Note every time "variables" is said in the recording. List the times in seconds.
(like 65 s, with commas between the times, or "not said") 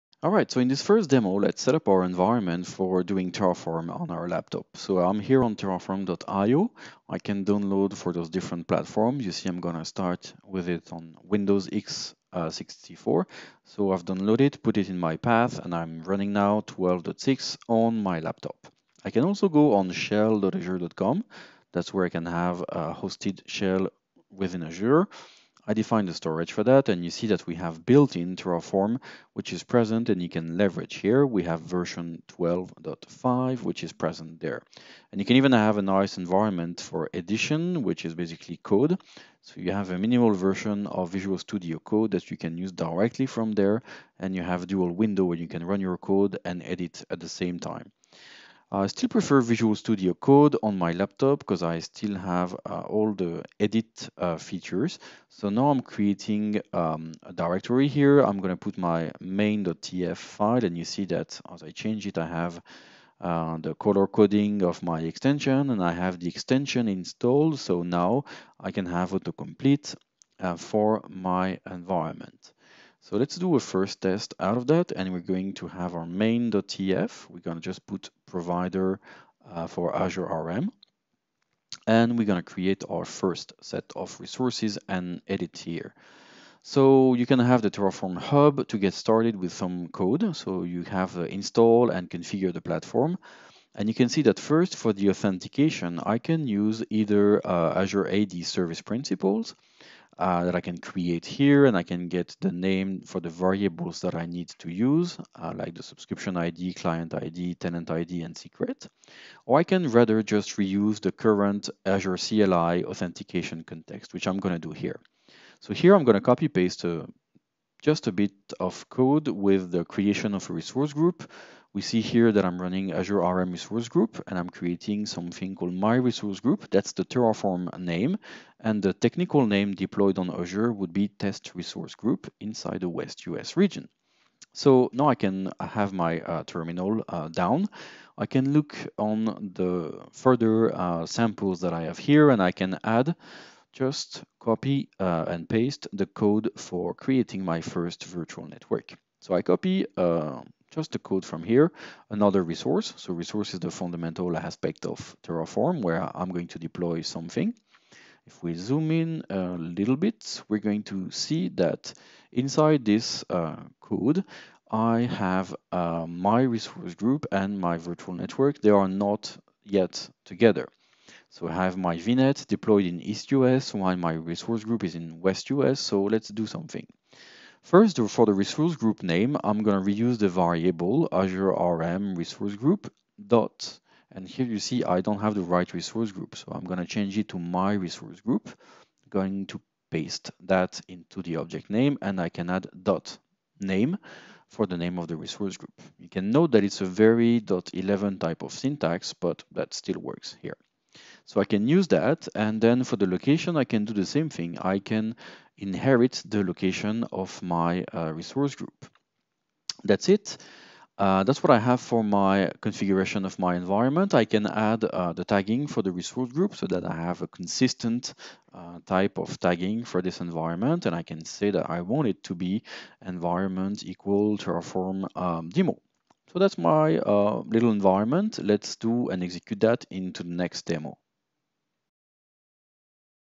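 103 s, 180 s.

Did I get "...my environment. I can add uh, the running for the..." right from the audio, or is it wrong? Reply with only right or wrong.
wrong.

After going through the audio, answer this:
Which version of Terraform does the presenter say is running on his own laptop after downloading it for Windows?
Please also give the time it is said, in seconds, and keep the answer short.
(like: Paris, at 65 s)
12.6, at 16 s.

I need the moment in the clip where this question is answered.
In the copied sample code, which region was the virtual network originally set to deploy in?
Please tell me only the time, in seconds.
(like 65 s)
173 s.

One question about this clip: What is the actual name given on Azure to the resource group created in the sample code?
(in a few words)
Test Resource Group.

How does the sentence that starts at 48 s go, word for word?
I still prefer Visual Studio Code on my laptop because I still have uh, all the edit uh, features.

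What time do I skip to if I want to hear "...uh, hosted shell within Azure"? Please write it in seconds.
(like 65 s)
22 s.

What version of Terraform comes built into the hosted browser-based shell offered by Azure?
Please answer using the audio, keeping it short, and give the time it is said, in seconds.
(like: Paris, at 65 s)
12.5, at 32 s.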